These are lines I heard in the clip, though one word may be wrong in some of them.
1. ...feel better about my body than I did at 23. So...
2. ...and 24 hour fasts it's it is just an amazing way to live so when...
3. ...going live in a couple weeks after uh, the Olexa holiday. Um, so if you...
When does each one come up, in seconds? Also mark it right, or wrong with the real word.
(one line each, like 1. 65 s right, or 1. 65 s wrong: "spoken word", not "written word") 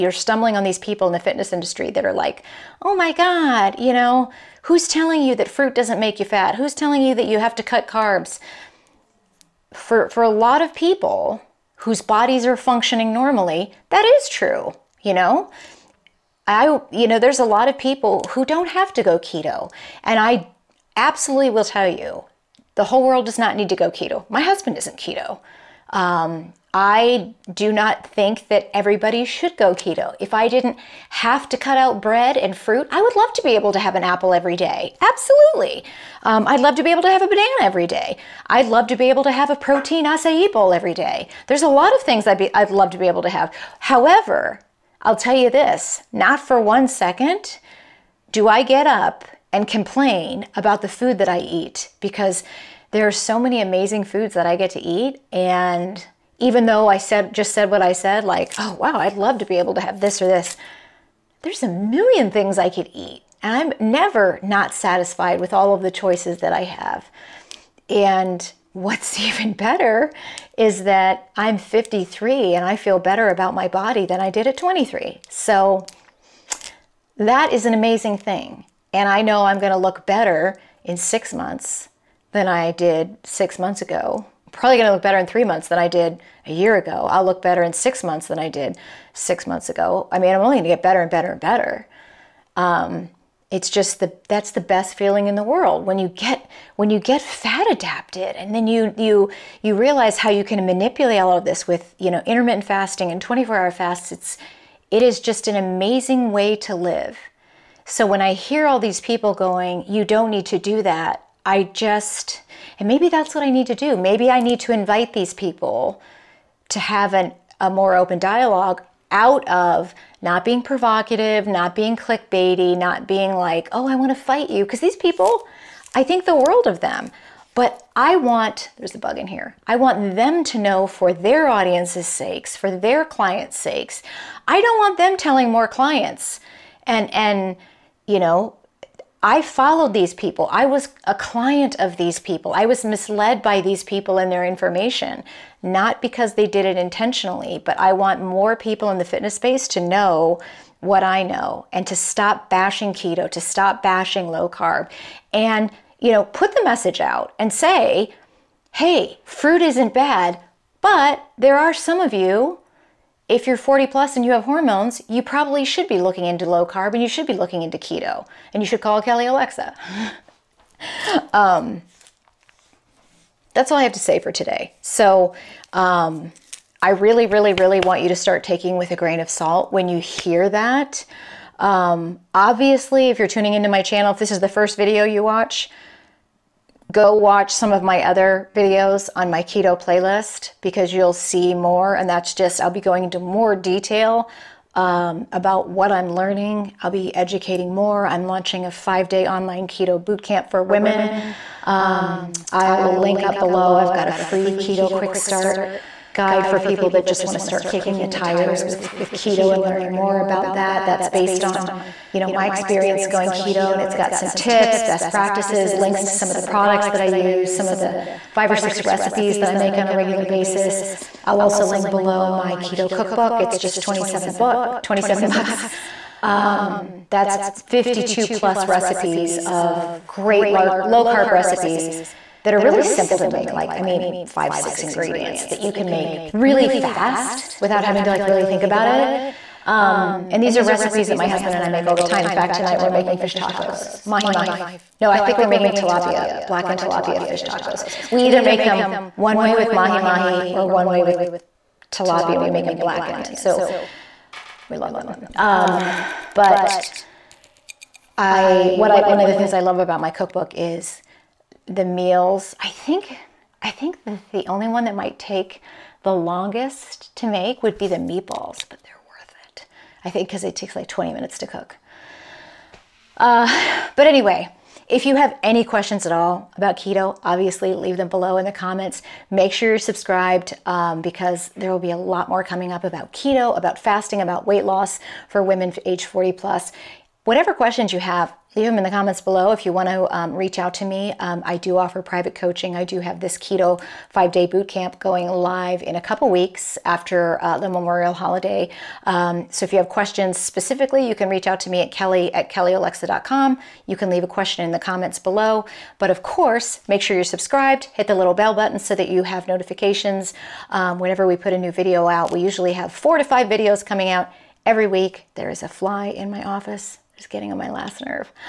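1. 72 s right
2. 103 s right
3. 294 s wrong: "Memorial", not "Olexa".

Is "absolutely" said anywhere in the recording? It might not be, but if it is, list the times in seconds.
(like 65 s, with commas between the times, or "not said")
20 s, 35 s.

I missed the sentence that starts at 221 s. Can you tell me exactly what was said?
I'll also link below my keto cookbook.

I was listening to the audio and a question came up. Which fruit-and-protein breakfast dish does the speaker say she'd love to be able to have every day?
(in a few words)
protein acai bowl.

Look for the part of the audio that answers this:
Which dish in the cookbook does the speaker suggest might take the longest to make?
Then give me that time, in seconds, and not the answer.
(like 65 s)
267 s.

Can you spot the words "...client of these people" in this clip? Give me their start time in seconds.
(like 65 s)
141 s.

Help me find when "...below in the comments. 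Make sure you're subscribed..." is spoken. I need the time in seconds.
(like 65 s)
278 s.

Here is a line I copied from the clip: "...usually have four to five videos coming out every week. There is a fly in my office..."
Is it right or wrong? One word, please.
right.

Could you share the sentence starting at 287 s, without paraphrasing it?
Whatever questions you have, leave them in the comments below.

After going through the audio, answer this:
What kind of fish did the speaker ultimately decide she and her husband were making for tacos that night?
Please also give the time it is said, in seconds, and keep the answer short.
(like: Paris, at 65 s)
blackened tilapia, at 246 s.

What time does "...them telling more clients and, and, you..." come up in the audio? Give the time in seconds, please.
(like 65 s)
134 s.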